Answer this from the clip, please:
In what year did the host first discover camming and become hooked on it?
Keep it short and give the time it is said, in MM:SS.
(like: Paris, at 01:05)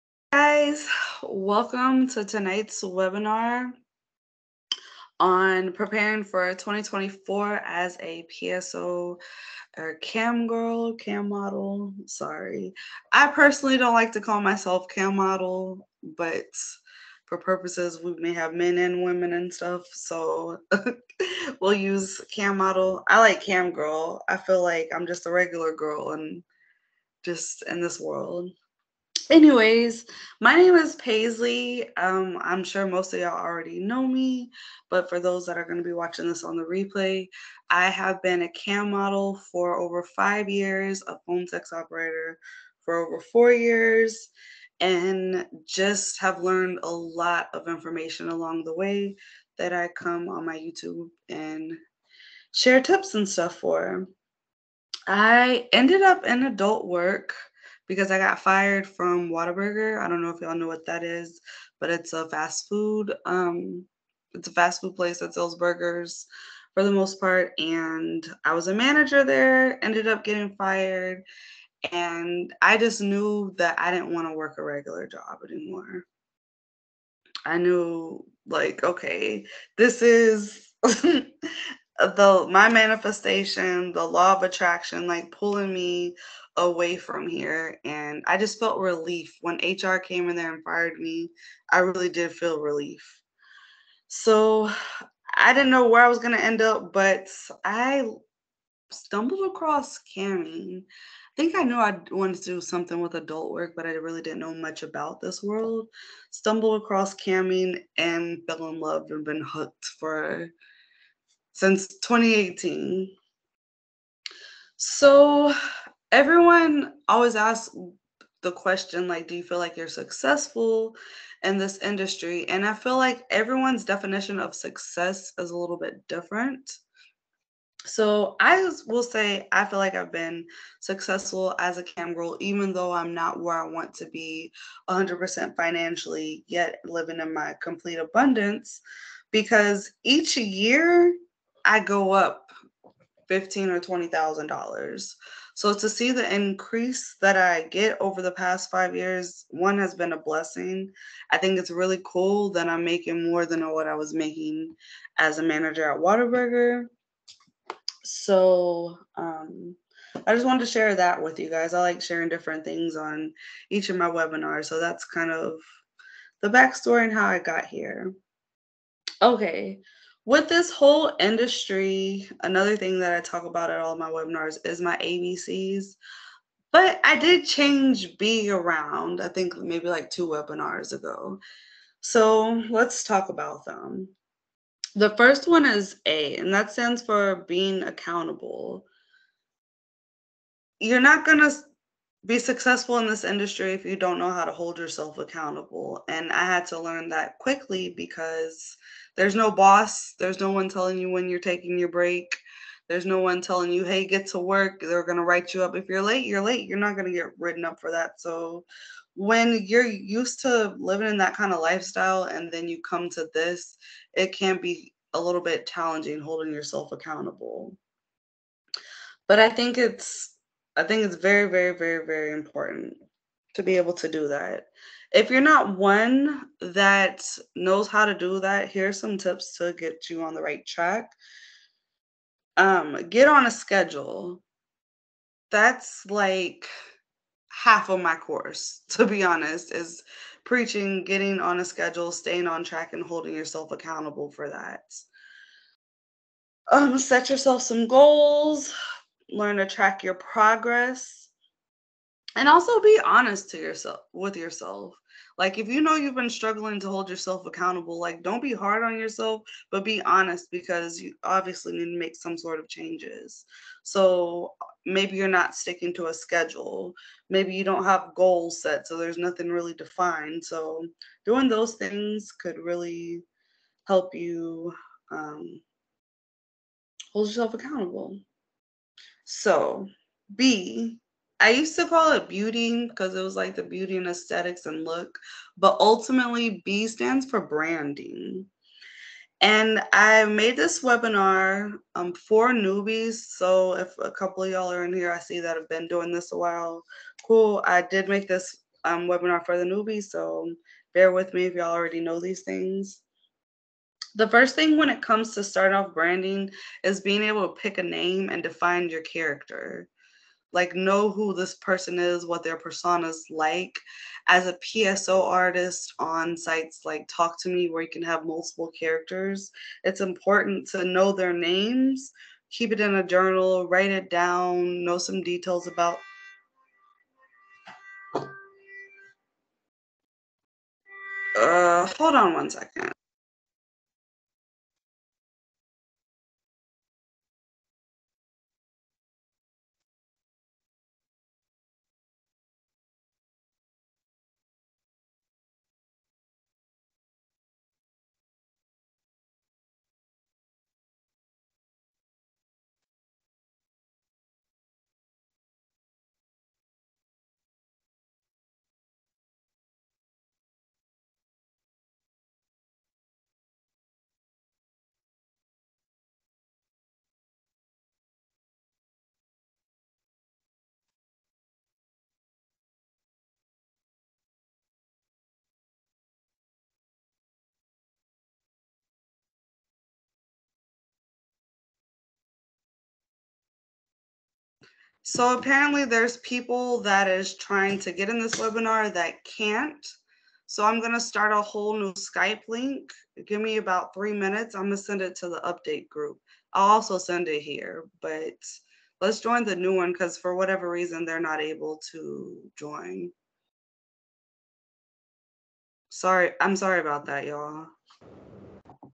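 2018, at 01:51.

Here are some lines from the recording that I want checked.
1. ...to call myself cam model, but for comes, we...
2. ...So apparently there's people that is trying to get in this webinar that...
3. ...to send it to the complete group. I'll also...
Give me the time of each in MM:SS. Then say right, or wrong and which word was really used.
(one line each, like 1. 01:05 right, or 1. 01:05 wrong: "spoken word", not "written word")
1. 00:14 wrong: "purposes", not "comes"
2. 06:25 right
3. 06:34 wrong: "update", not "complete".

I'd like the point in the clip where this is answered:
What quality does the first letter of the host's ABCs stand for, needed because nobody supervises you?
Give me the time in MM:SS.
03:07.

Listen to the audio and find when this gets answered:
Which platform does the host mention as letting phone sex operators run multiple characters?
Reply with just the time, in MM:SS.
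05:17.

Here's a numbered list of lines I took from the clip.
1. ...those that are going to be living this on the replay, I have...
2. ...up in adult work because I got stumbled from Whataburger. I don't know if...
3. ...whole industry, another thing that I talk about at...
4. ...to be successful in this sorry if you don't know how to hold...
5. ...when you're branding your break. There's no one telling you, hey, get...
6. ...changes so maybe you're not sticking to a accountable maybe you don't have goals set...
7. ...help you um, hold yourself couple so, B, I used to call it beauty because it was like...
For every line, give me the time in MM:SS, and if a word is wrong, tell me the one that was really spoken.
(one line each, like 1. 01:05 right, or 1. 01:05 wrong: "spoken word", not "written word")
1. 00:35 wrong: "watching", not "living"
2. 00:56 wrong: "fired", not "stumbled"
3. 02:50 right
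4. 03:11 wrong: "industry", not "sorry"
5. 03:21 wrong: "taking", not "branding"
6. 04:22 wrong: "schedule", not "accountable"
7. 04:33 wrong: "accountable", not "couple".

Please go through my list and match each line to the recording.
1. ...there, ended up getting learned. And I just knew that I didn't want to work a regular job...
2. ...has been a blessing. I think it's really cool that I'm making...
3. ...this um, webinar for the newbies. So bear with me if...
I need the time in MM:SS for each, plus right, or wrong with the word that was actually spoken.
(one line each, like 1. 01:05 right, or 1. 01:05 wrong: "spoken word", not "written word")
1. 01:09 wrong: "fired", not "learned"
2. 02:29 right
3. 04:58 right.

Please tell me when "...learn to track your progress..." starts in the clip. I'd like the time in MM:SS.
04:09.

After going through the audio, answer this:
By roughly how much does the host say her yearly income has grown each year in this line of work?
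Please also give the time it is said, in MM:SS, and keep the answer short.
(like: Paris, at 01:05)
15 or 20 thousand dollars, at 02:23.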